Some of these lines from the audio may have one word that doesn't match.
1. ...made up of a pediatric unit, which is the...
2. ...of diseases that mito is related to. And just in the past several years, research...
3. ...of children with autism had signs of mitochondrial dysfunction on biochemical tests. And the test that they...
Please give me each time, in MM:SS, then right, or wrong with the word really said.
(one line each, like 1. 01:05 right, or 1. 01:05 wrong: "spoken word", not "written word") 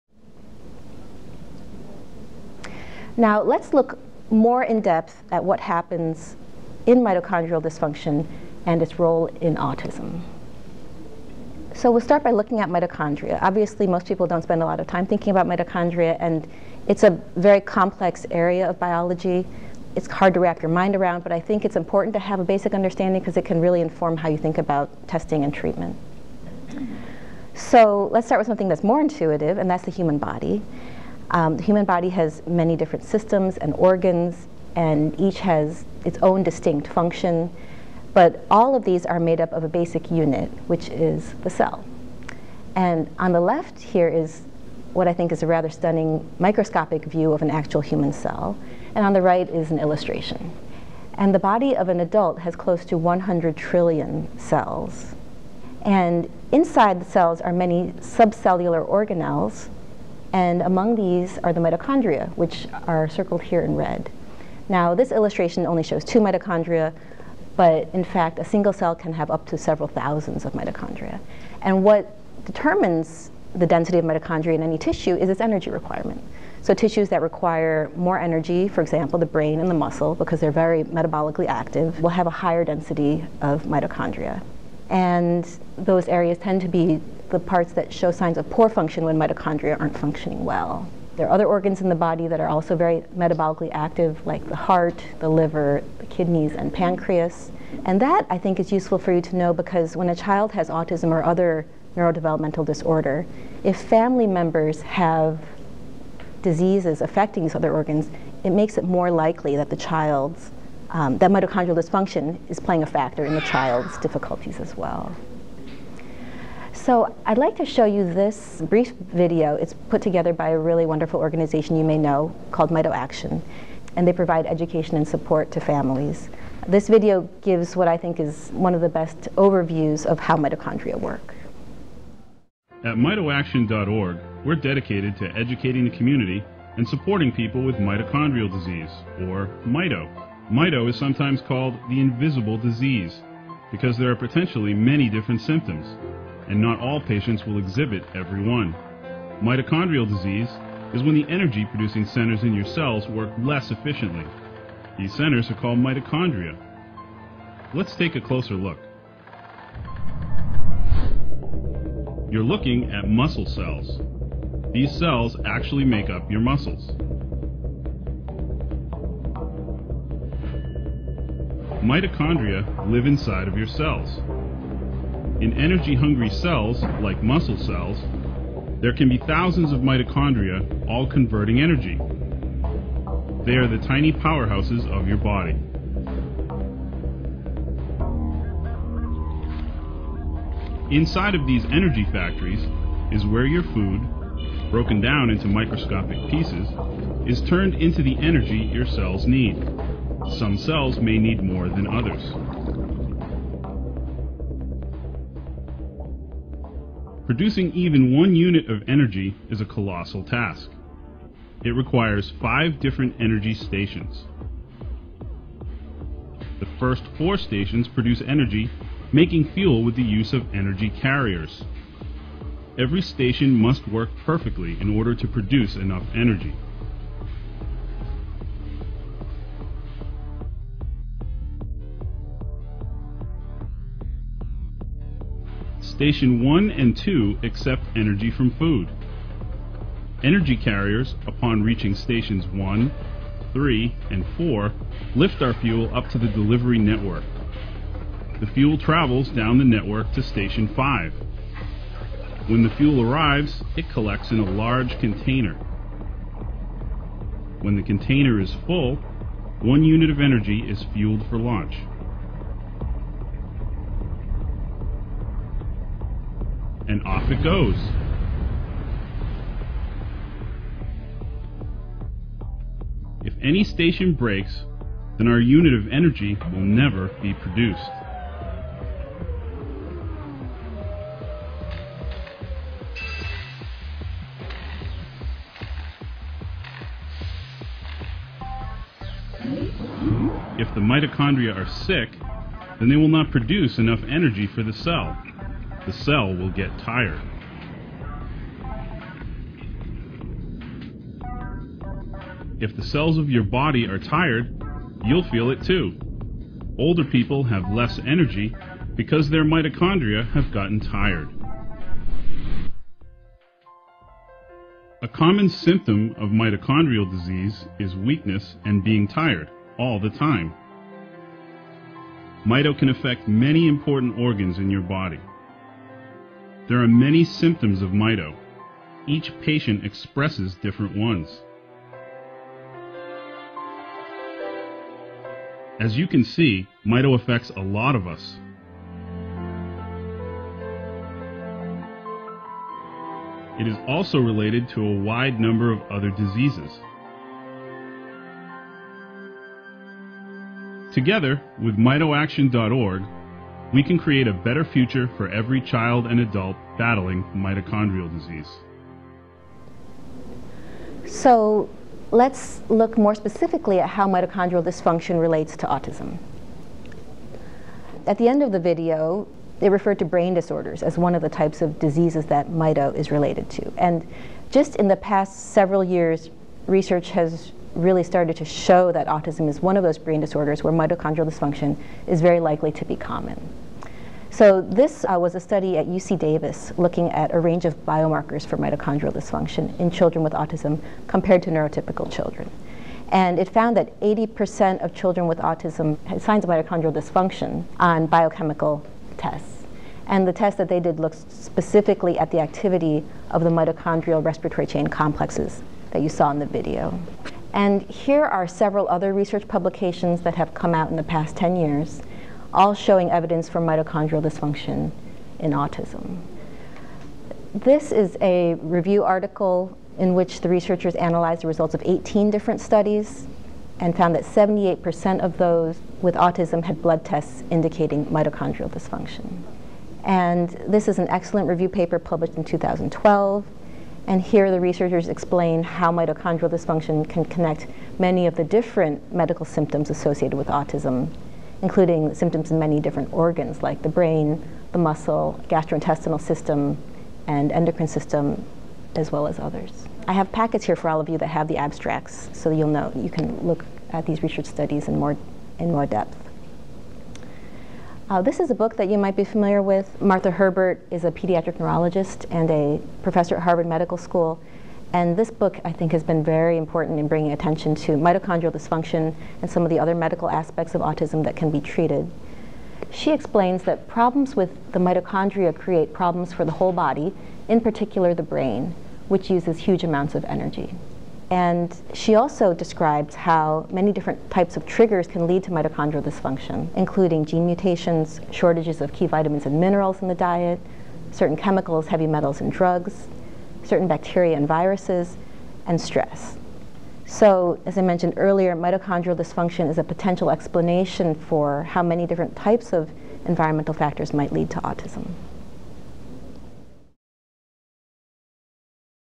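1. 00:39 wrong: "basic", not "pediatric"
2. 06:11 right
3. 06:34 right.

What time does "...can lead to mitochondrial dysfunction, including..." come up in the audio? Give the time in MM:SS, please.
08:05.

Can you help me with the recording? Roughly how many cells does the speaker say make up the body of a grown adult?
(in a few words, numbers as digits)
100 trillion.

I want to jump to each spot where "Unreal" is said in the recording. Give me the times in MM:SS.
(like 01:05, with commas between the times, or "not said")
not said.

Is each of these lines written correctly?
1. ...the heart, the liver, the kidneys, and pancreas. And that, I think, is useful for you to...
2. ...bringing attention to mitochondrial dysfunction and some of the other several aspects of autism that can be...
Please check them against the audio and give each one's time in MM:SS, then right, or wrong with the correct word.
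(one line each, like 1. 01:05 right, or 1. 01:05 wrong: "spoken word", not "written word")
1. 01:34 right
2. 07:47 wrong: "medical", not "several".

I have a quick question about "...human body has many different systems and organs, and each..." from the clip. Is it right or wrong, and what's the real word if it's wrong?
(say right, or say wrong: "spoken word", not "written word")
right.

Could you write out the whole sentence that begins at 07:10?
And this is an excellent review paper published in 2012.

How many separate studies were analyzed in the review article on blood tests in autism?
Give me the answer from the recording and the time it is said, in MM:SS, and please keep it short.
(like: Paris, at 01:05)
18, at 07:01.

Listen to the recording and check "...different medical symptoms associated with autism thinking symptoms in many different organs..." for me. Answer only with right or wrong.
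wrong.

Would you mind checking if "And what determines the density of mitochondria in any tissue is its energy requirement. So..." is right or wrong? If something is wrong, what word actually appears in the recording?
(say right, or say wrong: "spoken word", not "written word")
right.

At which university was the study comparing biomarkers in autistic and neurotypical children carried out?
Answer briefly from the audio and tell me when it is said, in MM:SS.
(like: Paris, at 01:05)
UC Davis, at 06:25.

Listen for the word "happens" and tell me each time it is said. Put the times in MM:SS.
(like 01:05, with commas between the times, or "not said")
00:05.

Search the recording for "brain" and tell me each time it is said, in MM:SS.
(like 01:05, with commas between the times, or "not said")
01:19, 06:10, 06:19, 07:23, 07:58.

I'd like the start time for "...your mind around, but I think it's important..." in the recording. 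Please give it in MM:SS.
00:20.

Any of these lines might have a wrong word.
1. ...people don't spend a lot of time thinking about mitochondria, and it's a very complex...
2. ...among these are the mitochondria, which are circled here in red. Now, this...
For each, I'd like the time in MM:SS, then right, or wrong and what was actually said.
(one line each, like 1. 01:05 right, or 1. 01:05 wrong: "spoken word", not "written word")
1. 00:14 right
2. 01:00 right.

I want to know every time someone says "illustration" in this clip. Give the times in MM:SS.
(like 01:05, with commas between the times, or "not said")
00:49, 01:05.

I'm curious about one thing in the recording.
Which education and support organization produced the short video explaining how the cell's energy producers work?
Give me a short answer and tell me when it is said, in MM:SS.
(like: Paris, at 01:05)
MitoAction, at 02:02.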